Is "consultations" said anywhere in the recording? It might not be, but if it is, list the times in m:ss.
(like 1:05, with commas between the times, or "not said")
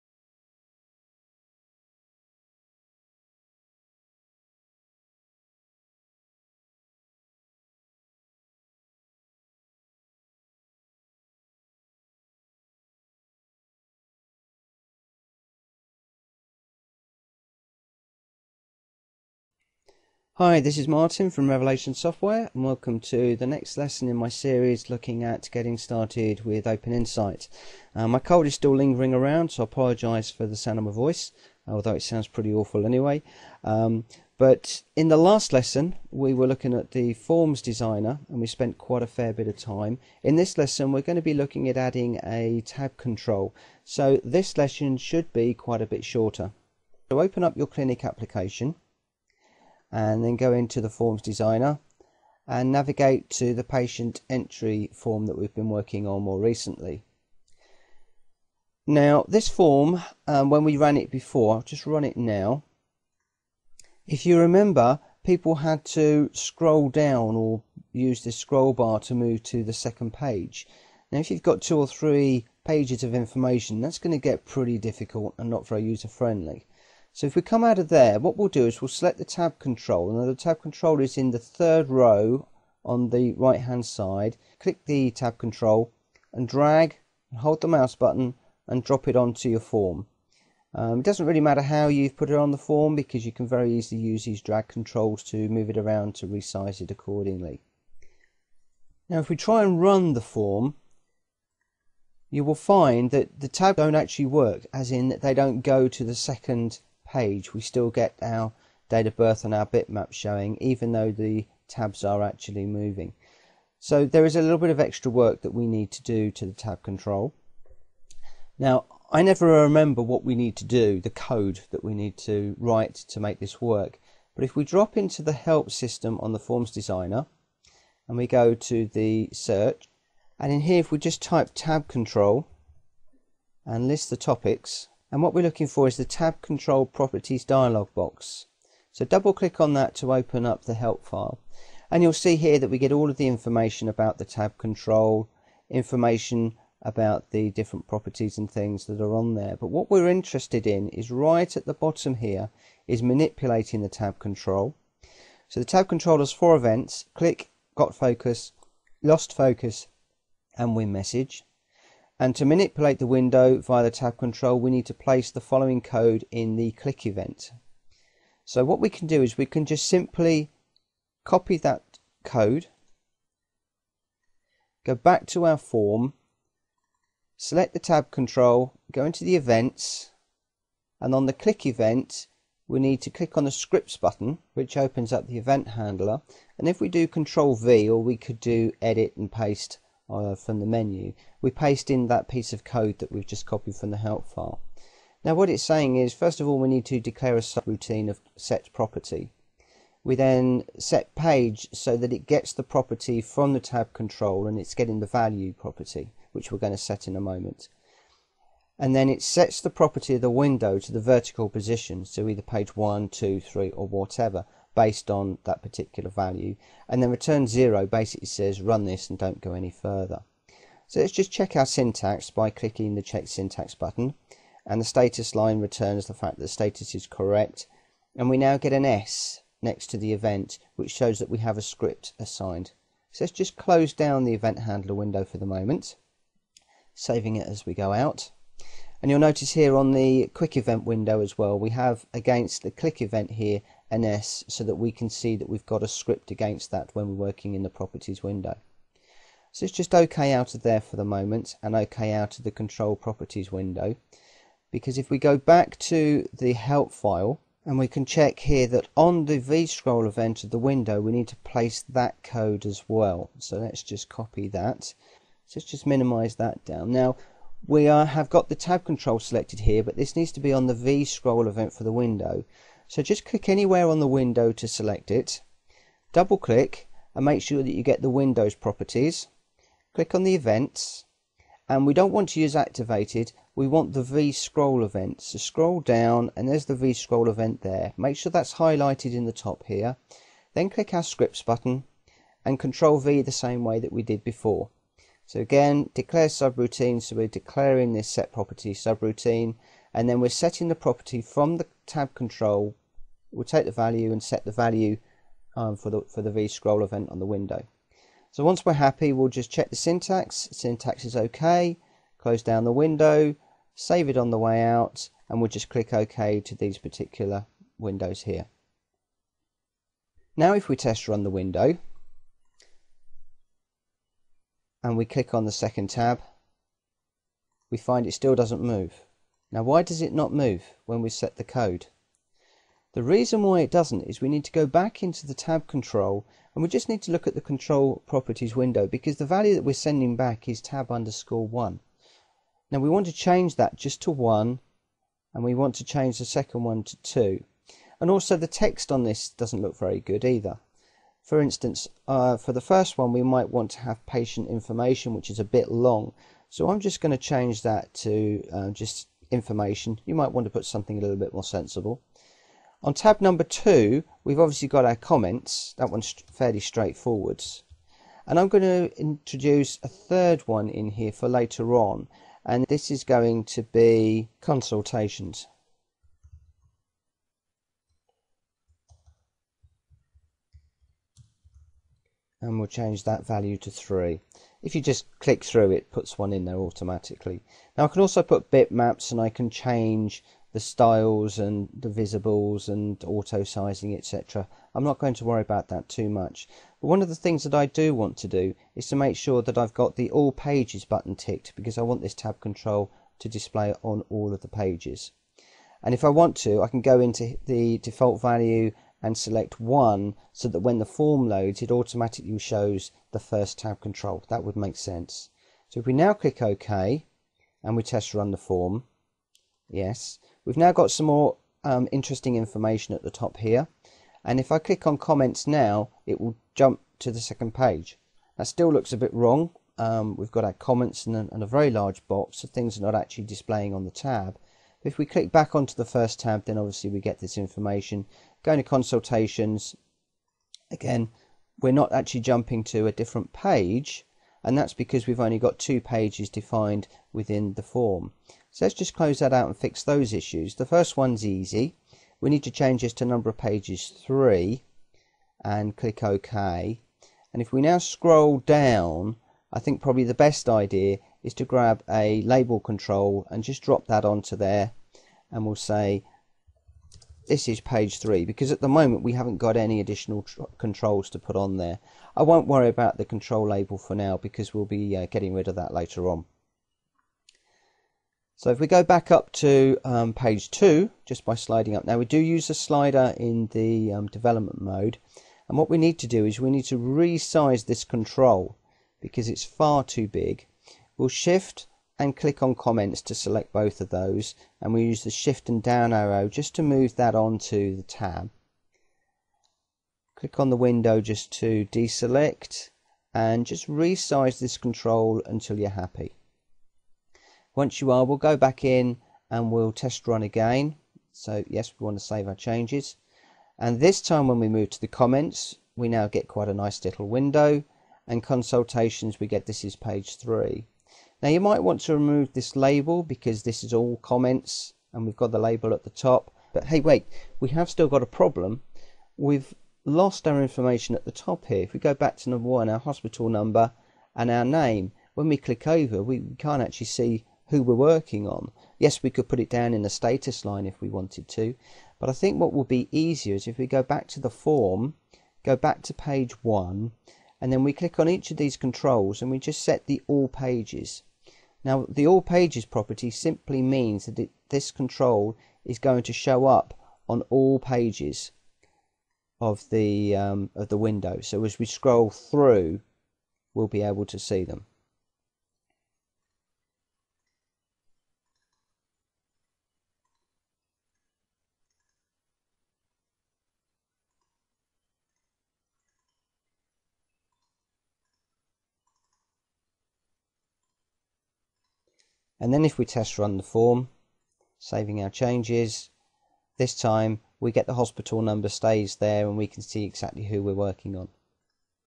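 6:14, 7:18, 8:38.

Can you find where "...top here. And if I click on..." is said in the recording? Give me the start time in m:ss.
7:03.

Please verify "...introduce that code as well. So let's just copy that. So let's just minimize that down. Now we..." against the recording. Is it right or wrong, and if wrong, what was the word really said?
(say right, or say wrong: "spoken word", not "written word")
wrong: "place", not "introduce".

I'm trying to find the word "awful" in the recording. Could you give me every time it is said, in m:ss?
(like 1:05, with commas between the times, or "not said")
0:32.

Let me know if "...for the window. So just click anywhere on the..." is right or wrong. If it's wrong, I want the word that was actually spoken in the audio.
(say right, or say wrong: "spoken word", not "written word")
right.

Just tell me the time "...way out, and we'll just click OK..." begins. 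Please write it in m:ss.
5:14.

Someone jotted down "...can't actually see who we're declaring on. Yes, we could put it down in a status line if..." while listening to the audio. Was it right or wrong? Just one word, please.
wrong.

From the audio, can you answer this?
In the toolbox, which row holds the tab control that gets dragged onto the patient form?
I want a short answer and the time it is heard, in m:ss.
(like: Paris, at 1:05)
third row, at 1:21.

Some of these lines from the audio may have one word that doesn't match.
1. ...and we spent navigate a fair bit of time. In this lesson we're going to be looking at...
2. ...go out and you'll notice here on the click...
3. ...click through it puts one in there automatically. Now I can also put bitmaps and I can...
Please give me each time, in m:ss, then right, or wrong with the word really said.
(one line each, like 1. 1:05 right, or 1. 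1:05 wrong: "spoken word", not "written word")
1. 0:38 wrong: "quite", not "navigate"
2. 3:57 wrong: "quick", not "click"
3. 6:25 right.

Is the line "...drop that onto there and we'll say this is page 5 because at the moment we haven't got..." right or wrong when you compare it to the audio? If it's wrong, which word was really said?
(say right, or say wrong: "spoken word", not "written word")
wrong: "3", not "5".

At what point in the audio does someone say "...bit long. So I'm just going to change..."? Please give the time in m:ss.
5:55.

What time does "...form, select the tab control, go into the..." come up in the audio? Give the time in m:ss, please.
2:55.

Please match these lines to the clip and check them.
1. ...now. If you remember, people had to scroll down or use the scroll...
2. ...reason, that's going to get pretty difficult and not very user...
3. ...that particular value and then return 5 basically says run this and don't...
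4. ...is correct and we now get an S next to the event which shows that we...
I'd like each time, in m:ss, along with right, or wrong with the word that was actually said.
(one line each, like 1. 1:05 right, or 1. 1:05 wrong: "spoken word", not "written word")
1. 1:02 right
2. 1:13 wrong: "information", not "reason"
3. 3:35 wrong: "0", not "5"
4. 3:46 right.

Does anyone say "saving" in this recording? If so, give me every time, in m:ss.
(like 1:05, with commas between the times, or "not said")
3:56, 9:44.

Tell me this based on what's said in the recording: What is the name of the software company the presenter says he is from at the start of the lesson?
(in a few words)
Revelation Software.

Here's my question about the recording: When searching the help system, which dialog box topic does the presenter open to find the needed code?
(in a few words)
tab control properties dialog box.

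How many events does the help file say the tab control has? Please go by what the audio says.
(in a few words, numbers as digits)
4.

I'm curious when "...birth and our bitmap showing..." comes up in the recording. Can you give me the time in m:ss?
1:49.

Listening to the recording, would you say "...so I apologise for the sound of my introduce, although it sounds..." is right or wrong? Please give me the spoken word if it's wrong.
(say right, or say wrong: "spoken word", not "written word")
wrong: "voice", not "introduce".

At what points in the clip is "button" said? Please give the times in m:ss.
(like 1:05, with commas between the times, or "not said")
1:27, 3:03, 3:43, 4:51, 6:40.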